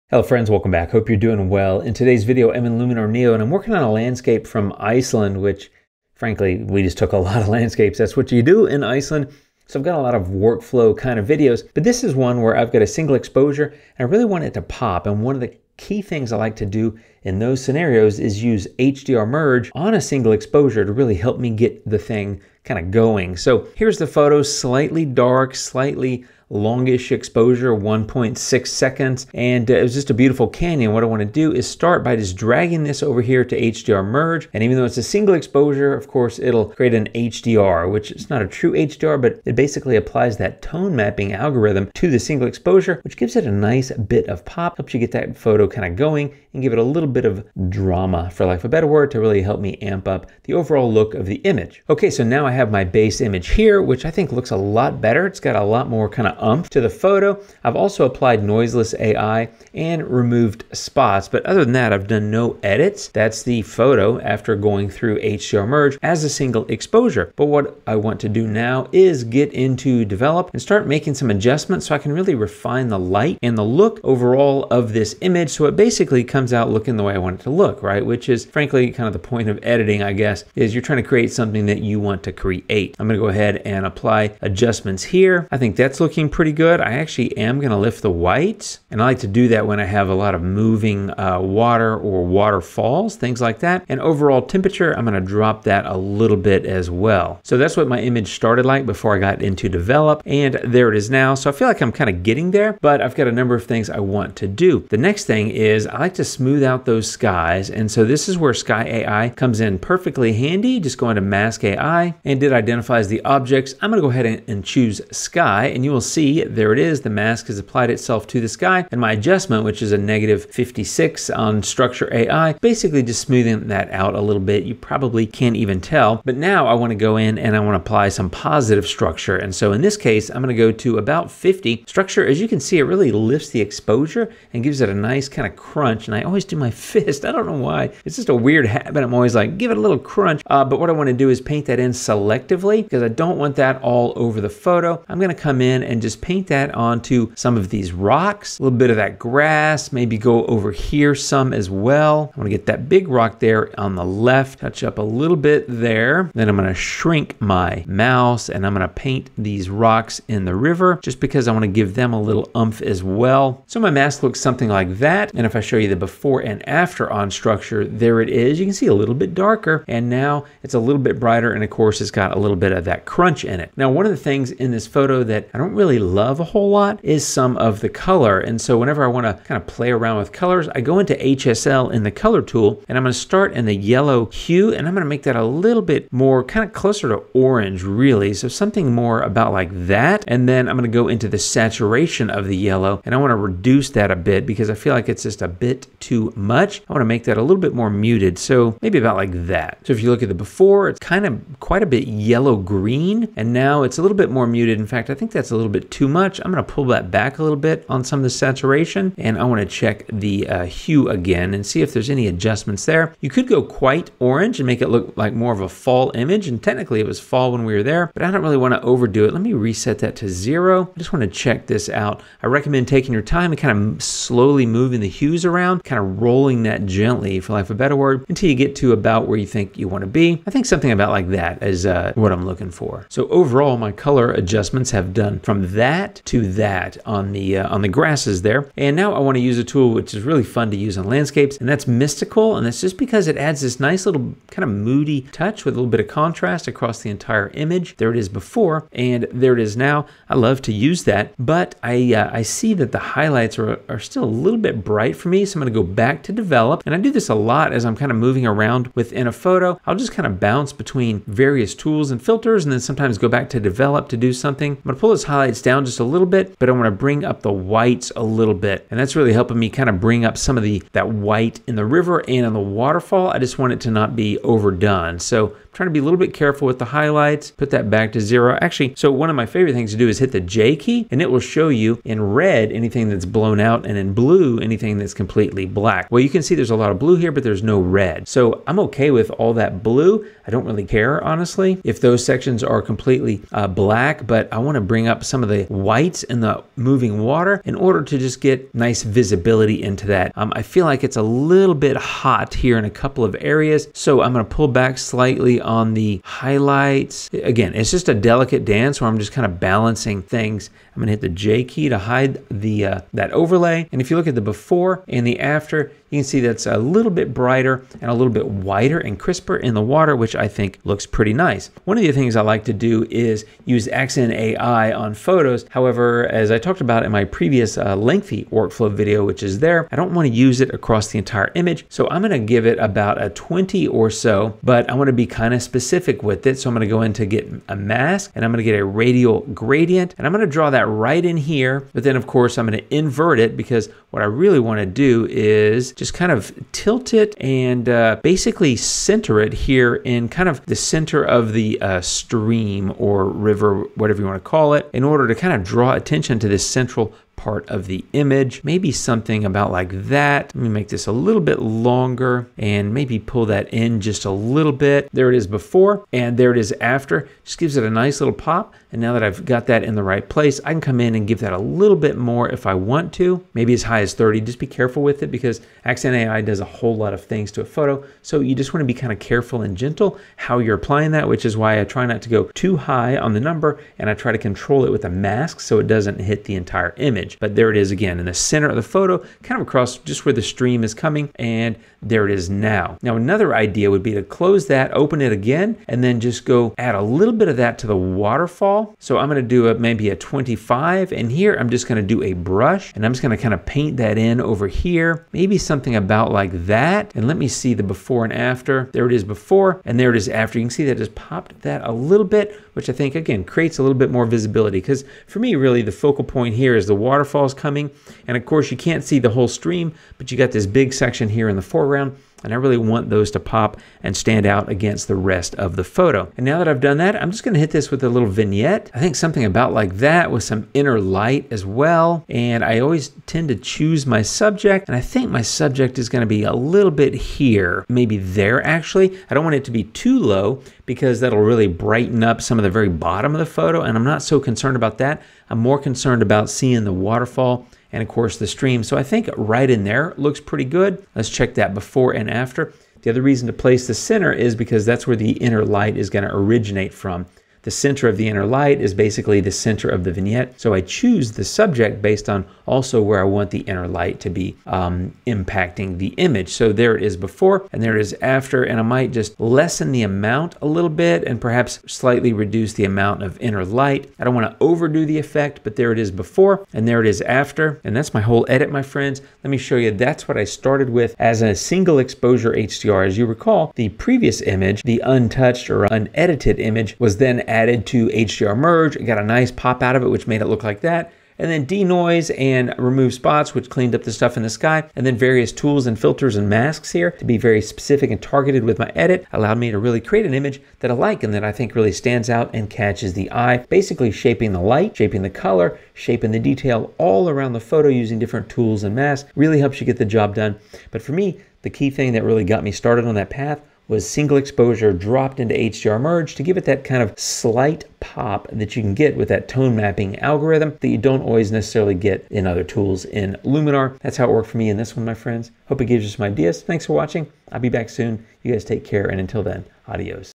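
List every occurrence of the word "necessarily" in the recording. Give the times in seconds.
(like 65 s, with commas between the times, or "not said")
521 s.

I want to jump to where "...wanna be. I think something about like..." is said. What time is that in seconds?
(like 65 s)
229 s.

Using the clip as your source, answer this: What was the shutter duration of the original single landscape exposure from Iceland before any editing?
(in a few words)
1.6 seconds.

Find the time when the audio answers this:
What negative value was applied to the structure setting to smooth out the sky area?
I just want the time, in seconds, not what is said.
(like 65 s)
119 s.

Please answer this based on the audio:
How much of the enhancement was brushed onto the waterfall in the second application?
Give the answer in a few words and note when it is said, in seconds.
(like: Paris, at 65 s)
25, at 400 s.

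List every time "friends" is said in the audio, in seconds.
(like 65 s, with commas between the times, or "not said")
0 s, 478 s, 525 s.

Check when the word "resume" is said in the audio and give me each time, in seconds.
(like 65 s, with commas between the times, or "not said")
not said.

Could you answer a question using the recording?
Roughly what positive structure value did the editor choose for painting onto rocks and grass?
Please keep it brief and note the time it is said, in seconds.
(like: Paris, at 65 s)
50, at 130 s.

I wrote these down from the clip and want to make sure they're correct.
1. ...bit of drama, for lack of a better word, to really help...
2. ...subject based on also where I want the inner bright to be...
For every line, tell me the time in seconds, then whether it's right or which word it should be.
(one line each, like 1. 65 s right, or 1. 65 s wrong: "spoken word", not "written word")
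1. 47 s right
2. 461 s wrong: "light", not "bright".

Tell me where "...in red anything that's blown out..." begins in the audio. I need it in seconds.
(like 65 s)
282 s.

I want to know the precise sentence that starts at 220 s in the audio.
I just wanna check this out.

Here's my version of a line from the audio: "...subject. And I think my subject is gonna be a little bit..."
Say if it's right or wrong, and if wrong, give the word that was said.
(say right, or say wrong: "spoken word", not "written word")
right.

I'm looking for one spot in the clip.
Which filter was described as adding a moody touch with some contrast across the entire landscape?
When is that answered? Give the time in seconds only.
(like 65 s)
242 s.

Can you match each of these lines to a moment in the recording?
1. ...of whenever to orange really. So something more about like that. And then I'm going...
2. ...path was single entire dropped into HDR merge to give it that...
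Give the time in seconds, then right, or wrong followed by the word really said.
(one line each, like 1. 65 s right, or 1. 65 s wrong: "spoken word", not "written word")
1. 186 s wrong: "closer", not "whenever"
2. 513 s wrong: "exposure", not "entire".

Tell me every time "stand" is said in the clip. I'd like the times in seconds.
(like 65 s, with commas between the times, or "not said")
424 s, 501 s.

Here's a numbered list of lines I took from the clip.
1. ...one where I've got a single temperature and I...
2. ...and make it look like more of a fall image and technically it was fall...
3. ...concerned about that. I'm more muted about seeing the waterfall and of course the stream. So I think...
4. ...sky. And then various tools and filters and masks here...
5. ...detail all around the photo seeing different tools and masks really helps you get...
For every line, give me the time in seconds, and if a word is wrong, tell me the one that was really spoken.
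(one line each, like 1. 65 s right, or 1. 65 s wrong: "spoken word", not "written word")
1. 12 s wrong: "exposure", not "temperature"
2. 214 s right
3. 444 s wrong: "concerned", not "muted"
4. 494 s right
5. 506 s wrong: "using", not "seeing".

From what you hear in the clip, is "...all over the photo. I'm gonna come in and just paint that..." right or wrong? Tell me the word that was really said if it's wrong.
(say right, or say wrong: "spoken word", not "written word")
right.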